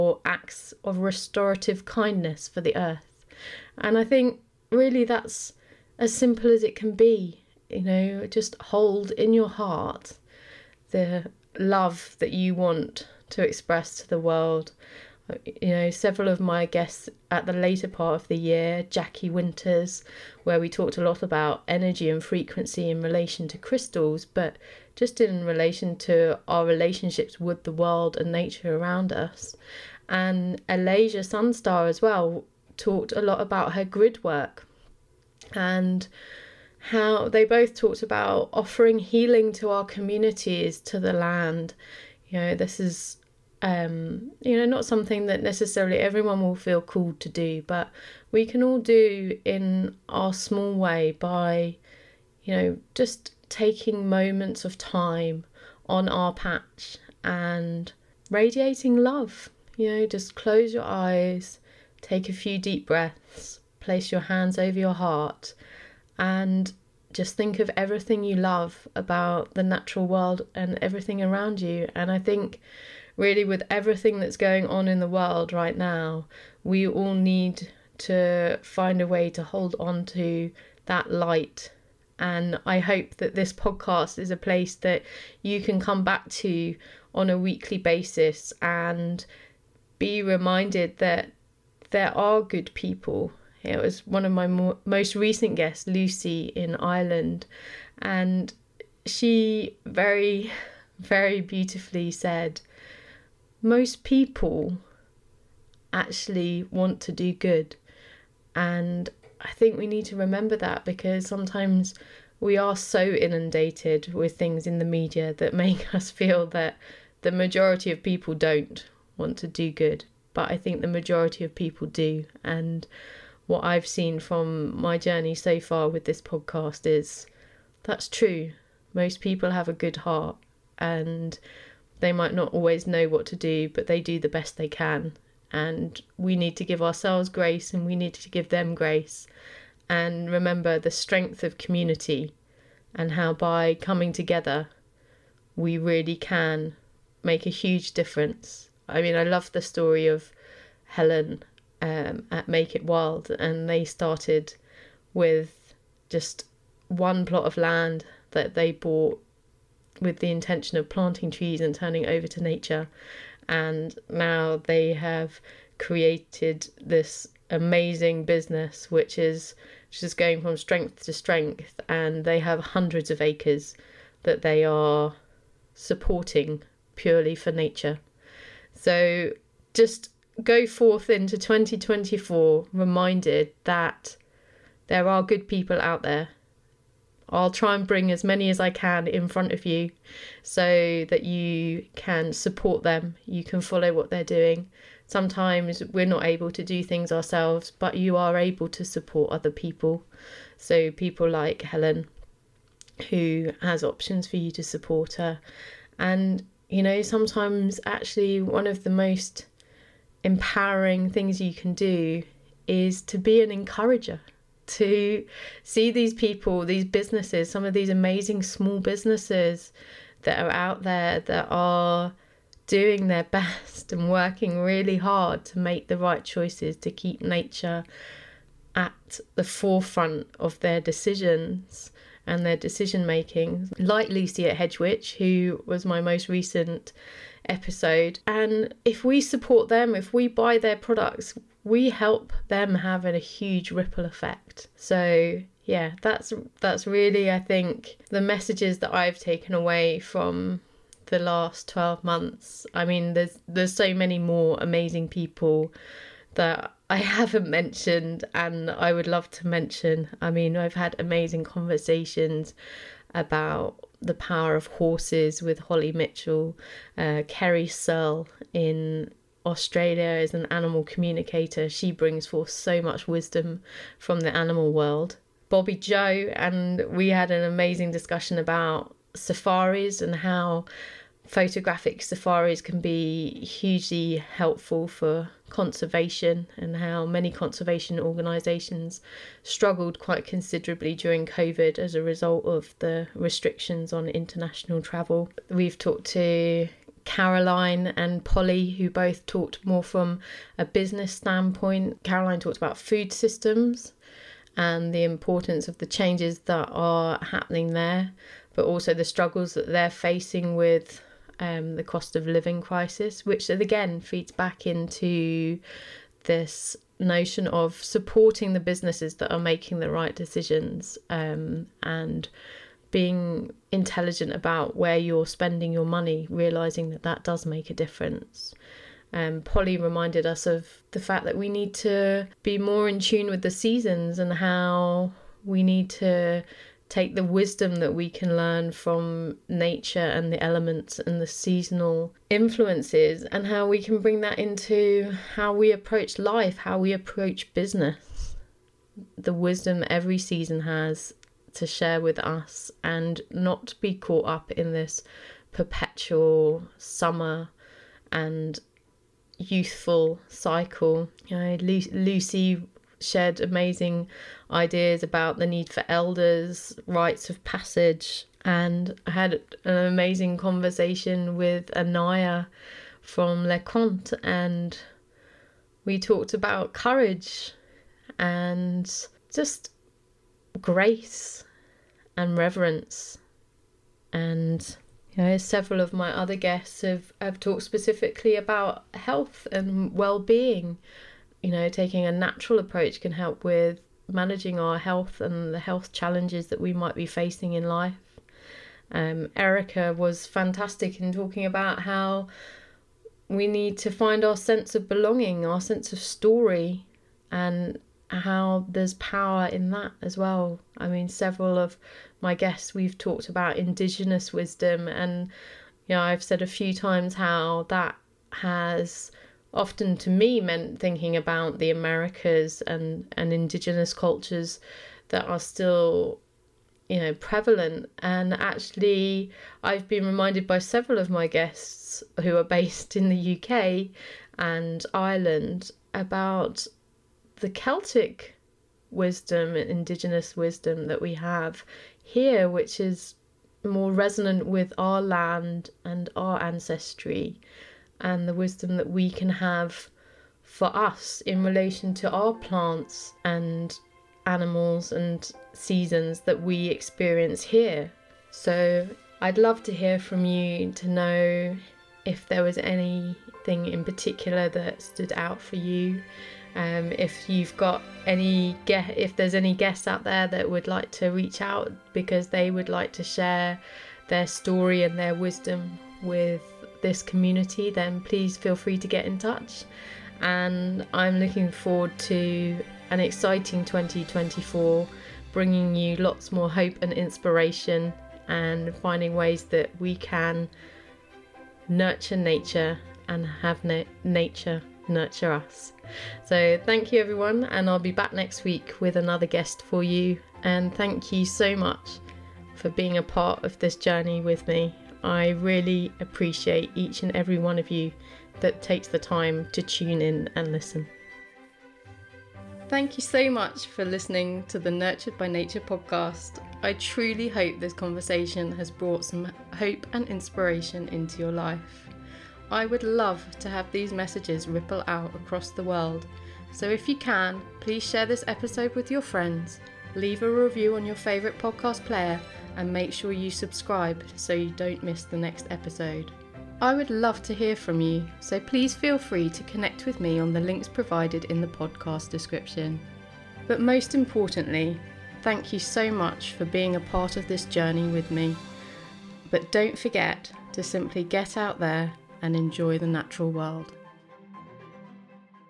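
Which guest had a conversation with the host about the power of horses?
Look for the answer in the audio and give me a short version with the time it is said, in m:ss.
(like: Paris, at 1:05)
Holly Mitchell, at 4:25.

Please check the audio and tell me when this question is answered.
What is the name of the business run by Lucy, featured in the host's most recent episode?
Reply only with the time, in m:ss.
3:54.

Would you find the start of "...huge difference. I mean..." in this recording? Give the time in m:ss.
2:27.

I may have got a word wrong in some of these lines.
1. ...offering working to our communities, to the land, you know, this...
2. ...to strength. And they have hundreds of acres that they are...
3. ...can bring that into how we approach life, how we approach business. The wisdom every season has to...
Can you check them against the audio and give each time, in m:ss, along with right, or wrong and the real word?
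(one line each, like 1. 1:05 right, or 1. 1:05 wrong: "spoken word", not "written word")
1. 0:38 wrong: "healing", not "working"
2. 2:51 right
3. 5:43 right.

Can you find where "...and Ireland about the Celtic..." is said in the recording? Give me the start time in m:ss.
7:14.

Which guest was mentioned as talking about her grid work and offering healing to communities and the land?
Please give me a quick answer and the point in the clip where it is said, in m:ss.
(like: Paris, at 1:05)
Alasia Sunstar, at 0:30.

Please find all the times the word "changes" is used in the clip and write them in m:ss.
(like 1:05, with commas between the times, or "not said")
5:05.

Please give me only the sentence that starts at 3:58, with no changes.
And if we support them, if we buy their products, we help them having a huge ripple effect.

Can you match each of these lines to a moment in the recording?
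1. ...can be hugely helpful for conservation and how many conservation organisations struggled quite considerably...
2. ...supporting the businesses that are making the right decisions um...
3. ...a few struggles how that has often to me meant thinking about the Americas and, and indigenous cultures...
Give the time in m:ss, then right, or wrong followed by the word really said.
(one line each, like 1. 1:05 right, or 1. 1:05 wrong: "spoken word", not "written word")
1. 4:42 right
2. 5:17 right
3. 6:56 wrong: "times", not "struggles".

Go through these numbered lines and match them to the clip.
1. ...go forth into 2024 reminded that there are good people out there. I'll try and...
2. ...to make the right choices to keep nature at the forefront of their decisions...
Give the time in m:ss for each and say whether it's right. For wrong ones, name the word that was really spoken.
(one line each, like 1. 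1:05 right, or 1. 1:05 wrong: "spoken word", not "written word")
1. 3:00 right
2. 3:45 right.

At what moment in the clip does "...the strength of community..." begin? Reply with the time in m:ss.
2:20.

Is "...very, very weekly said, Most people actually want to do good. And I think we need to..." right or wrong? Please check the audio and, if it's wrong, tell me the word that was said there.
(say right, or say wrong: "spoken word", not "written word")
wrong: "beautifully", not "weekly".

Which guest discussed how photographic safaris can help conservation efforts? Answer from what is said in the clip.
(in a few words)
Bobby Joe.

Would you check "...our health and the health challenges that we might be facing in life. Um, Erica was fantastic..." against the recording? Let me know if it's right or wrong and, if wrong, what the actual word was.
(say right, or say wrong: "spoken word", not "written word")
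right.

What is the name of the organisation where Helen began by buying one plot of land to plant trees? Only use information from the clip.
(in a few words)
Make It Wild.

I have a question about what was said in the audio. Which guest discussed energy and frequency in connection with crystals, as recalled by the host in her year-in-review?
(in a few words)
Jackie Winters.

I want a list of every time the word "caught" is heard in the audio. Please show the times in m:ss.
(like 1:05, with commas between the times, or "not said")
5:53.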